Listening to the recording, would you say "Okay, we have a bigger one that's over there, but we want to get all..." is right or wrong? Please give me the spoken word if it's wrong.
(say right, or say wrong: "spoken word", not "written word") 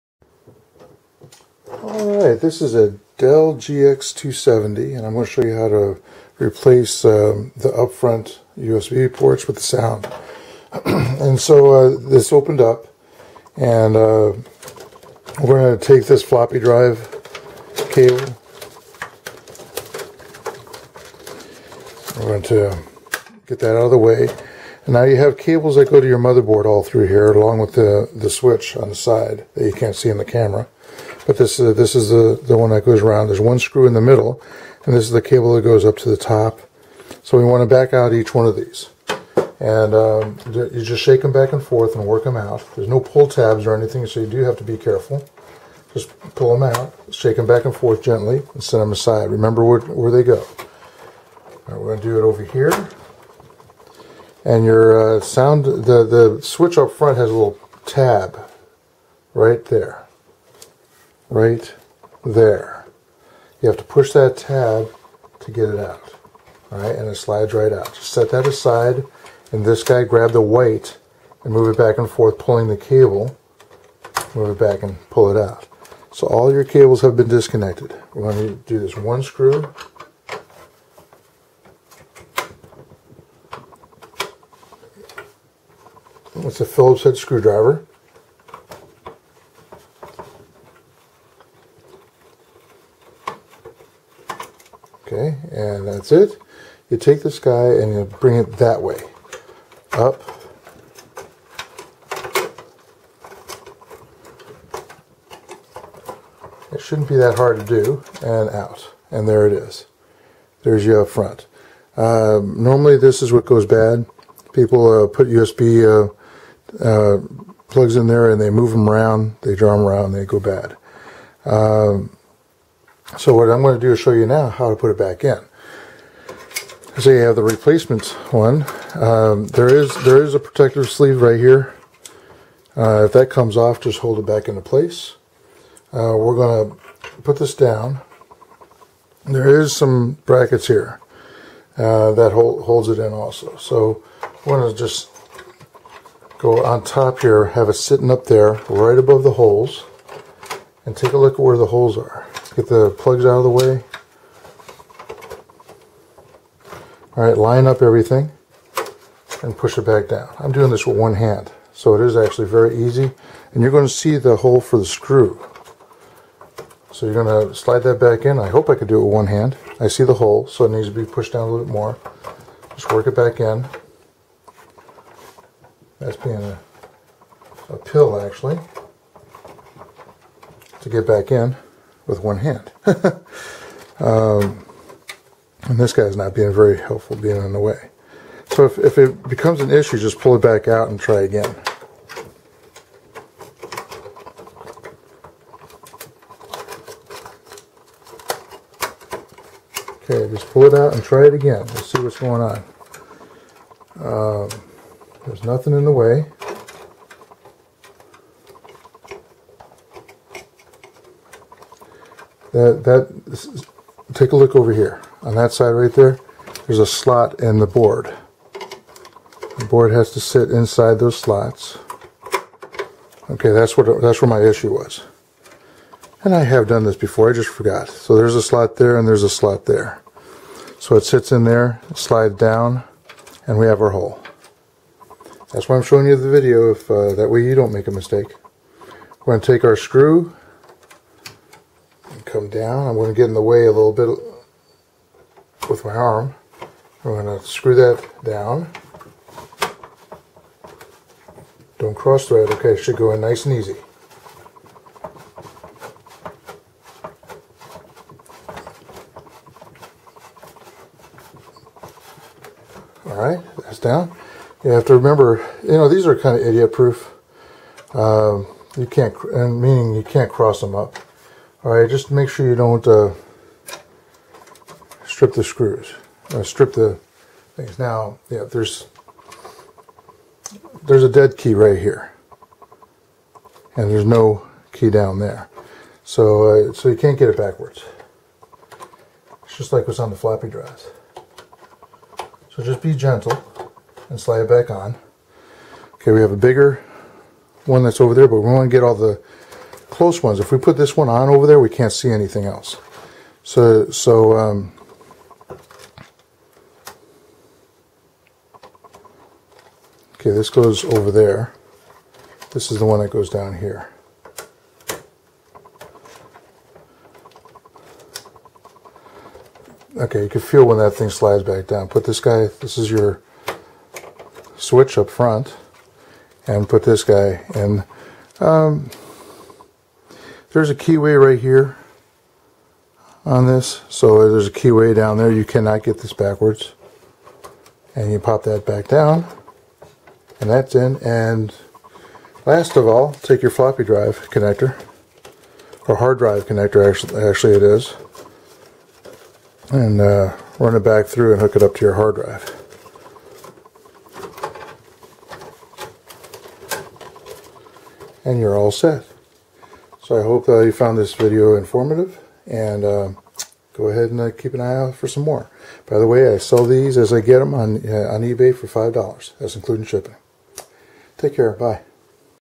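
right.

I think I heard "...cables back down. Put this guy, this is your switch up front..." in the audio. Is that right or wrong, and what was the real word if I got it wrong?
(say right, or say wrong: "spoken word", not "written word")
wrong: "slides", not "cables".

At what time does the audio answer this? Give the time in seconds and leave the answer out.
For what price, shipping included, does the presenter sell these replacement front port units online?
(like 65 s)
368 s.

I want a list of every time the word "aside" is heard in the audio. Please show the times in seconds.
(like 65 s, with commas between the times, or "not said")
48 s, 68 s.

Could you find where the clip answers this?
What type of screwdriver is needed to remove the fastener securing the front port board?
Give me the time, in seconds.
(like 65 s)
86 s.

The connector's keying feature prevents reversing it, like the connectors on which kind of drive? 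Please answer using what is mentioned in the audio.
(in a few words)
floppy drives.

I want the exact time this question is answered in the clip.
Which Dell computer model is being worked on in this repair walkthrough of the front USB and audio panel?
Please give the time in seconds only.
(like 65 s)
3 s.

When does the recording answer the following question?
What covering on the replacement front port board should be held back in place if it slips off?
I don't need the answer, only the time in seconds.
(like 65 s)
130 s.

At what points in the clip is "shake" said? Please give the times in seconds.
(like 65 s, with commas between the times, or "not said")
41 s, 47 s.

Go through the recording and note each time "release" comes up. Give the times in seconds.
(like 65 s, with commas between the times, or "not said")
not said.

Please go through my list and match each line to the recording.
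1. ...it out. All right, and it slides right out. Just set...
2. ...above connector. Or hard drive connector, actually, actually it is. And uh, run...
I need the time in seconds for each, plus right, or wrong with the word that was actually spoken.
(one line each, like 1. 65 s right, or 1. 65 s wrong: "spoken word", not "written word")
1. 65 s right
2. 343 s wrong: "drive", not "above".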